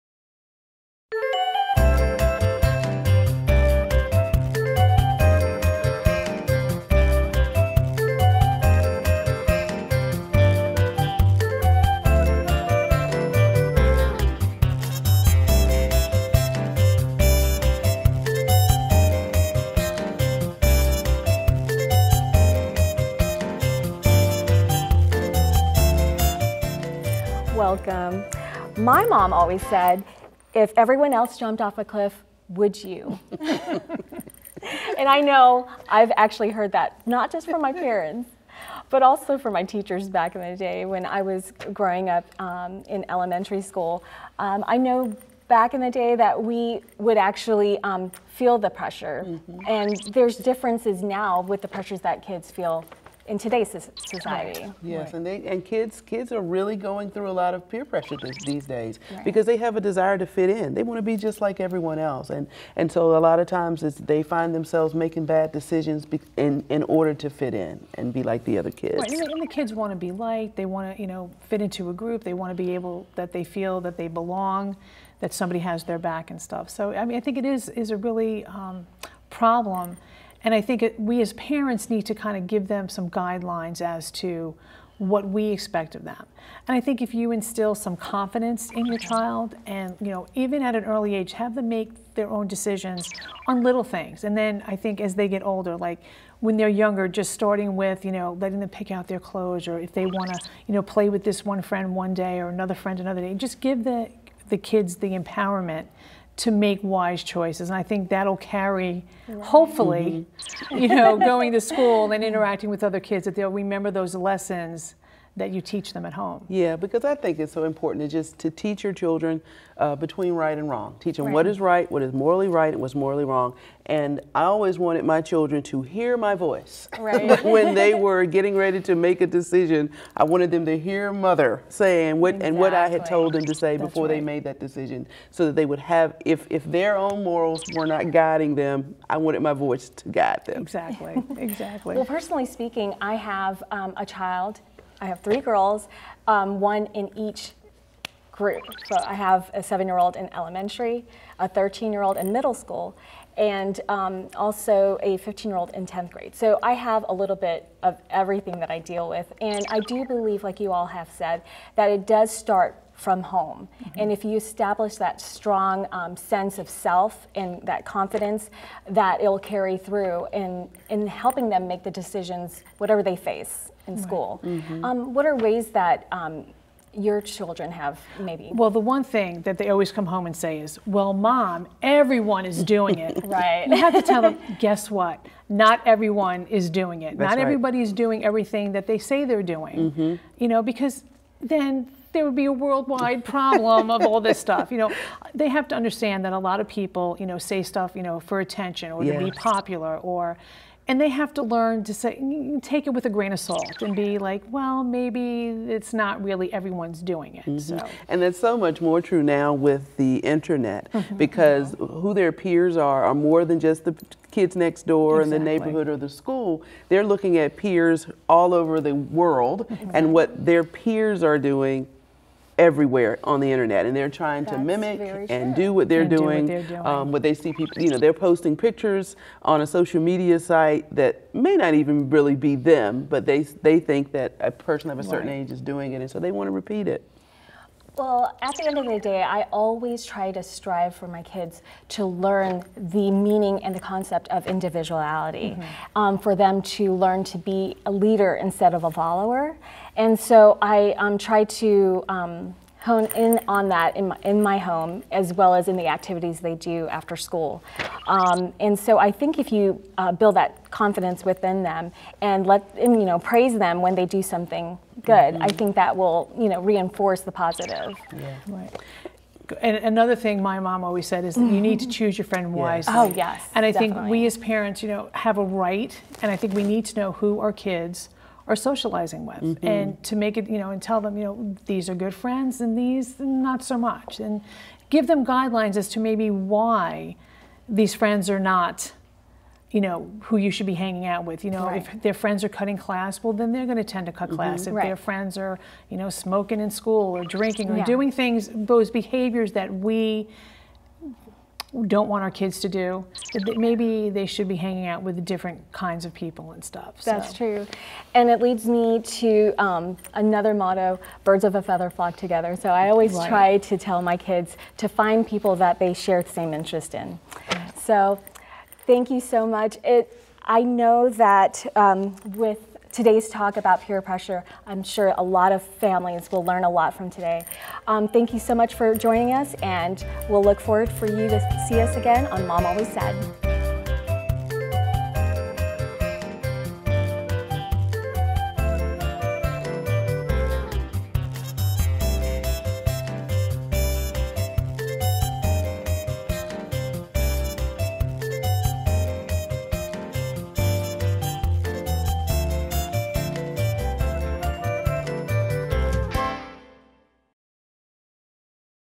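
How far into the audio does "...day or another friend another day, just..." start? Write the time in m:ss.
1:42.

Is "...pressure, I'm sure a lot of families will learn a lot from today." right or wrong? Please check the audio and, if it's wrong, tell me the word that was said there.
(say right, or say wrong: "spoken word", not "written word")
right.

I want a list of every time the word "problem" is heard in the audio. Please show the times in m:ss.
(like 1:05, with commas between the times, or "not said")
1:19, 3:13.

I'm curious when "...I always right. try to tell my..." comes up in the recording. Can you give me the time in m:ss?
5:12.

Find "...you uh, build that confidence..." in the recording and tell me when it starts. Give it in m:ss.
4:19.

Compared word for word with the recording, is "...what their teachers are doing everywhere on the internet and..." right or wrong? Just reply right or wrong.
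wrong.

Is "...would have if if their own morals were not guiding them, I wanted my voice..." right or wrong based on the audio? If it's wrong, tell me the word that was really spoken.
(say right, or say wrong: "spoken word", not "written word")
right.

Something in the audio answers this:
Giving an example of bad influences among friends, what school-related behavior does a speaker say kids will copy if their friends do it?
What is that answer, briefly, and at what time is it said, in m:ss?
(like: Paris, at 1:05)
cutting class, at 4:52.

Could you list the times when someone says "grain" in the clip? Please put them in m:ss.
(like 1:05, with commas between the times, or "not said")
3:23.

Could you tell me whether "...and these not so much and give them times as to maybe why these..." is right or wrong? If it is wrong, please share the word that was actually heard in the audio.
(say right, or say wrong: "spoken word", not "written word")
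wrong: "guidelines", not "times".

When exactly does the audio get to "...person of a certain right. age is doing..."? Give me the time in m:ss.
3:54.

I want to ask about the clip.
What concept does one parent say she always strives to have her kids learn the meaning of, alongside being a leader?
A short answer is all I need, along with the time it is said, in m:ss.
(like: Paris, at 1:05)
individuality, at 4:04.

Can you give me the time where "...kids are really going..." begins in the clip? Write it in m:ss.
0:56.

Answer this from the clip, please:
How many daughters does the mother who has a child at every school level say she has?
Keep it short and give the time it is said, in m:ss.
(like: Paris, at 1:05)
3, at 2:25.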